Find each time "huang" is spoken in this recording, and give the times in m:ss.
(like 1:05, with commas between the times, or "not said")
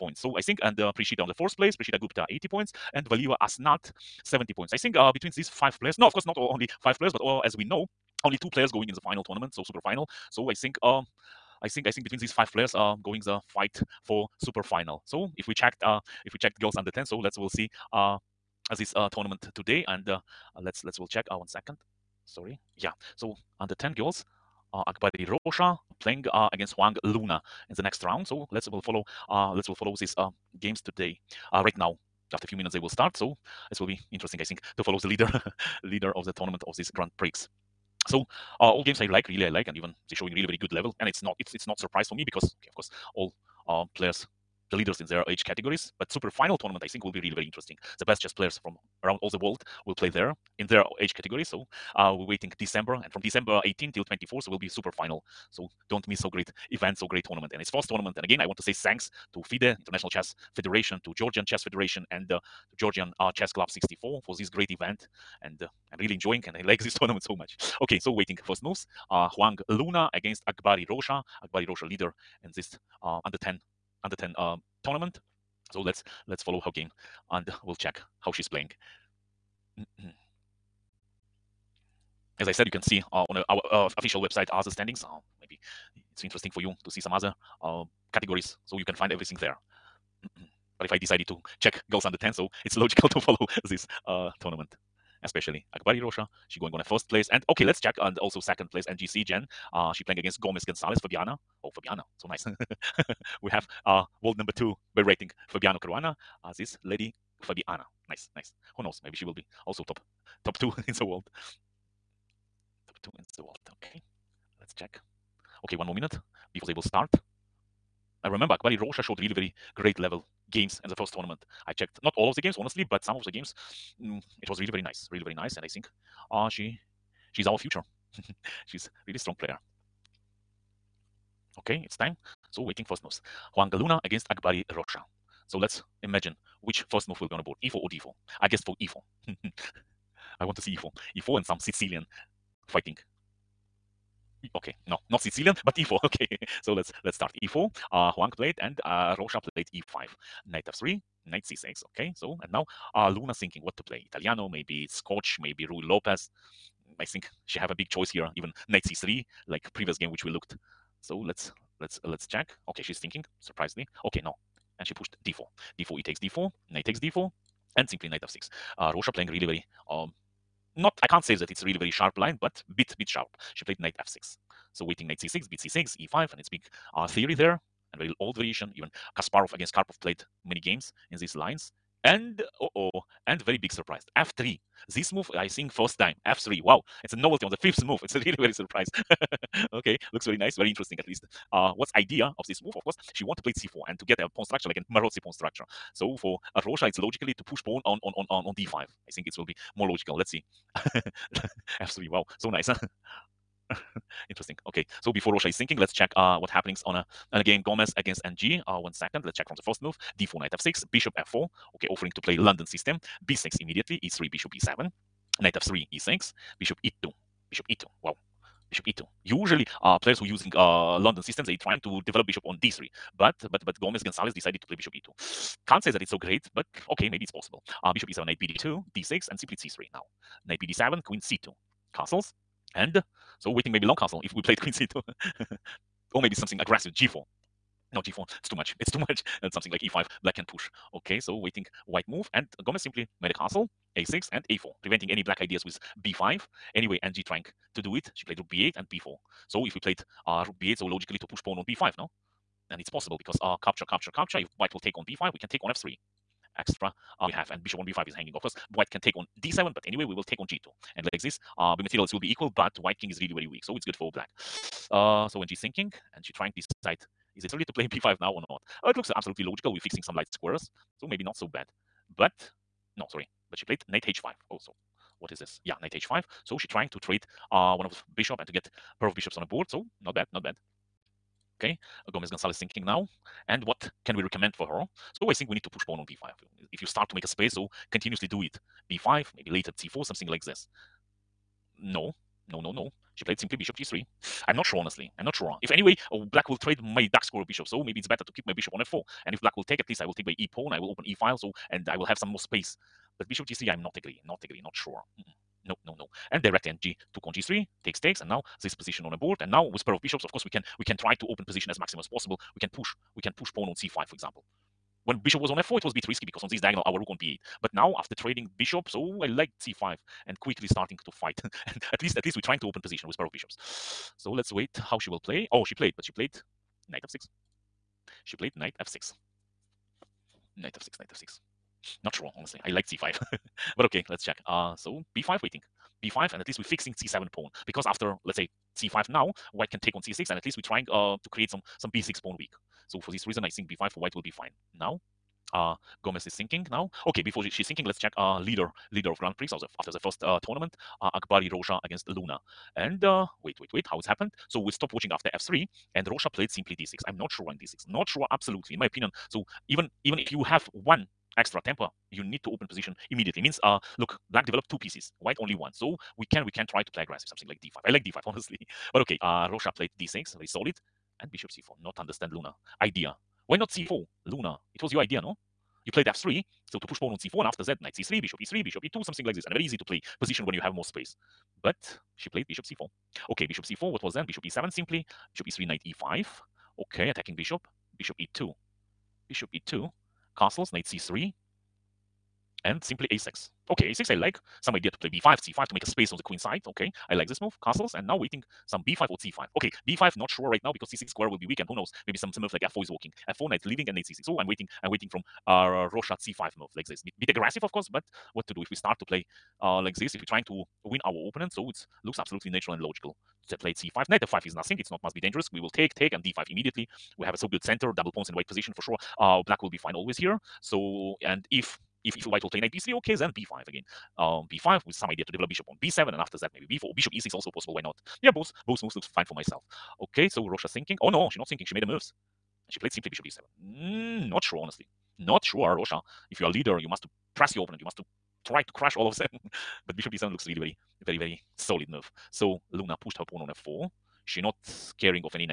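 0:26, 1:09, 2:28.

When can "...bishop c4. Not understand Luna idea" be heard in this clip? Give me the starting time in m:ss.
6:11.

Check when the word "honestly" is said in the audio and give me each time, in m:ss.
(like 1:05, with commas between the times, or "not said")
2:02, 4:54, 5:32, 6:08, 7:14.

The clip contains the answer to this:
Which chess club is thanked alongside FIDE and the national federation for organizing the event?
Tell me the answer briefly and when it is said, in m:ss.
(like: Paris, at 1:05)
Chess Club 64, at 1:03.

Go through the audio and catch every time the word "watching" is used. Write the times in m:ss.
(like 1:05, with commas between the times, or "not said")
5:54.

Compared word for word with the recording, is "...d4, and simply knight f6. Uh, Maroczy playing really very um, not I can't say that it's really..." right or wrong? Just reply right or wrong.
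wrong.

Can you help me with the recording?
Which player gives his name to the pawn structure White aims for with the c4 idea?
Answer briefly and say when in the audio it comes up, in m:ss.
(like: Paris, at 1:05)
Maroczy, at 3:14.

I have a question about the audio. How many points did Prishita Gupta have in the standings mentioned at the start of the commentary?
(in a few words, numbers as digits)
80.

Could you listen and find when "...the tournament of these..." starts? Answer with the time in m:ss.
0:36.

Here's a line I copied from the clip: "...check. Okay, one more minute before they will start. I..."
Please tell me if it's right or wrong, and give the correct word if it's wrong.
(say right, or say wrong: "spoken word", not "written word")
right.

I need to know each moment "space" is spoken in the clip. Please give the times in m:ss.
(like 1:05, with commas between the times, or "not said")
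4:47, 5:02, 6:20, 6:35.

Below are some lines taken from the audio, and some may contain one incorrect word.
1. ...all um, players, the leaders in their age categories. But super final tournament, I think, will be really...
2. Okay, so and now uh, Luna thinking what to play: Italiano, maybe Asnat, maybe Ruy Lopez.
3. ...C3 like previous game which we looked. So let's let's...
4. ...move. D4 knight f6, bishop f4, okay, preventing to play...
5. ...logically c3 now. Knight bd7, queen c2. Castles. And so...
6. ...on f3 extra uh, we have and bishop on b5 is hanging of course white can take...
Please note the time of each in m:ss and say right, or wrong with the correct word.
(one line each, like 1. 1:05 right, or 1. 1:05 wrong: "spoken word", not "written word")
1. 0:43 right
2. 2:31 wrong: "Scotch", not "Asnat"
3. 2:38 right
4. 3:29 wrong: "offering", not "preventing"
5. 3:49 wrong: "simply", not "logically"
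6. 4:15 right.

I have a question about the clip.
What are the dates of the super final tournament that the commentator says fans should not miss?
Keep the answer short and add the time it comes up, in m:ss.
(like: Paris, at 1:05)
December 18 to 24, at 0:53.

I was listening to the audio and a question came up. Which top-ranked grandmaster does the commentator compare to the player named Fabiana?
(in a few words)
Fabiano Caruana.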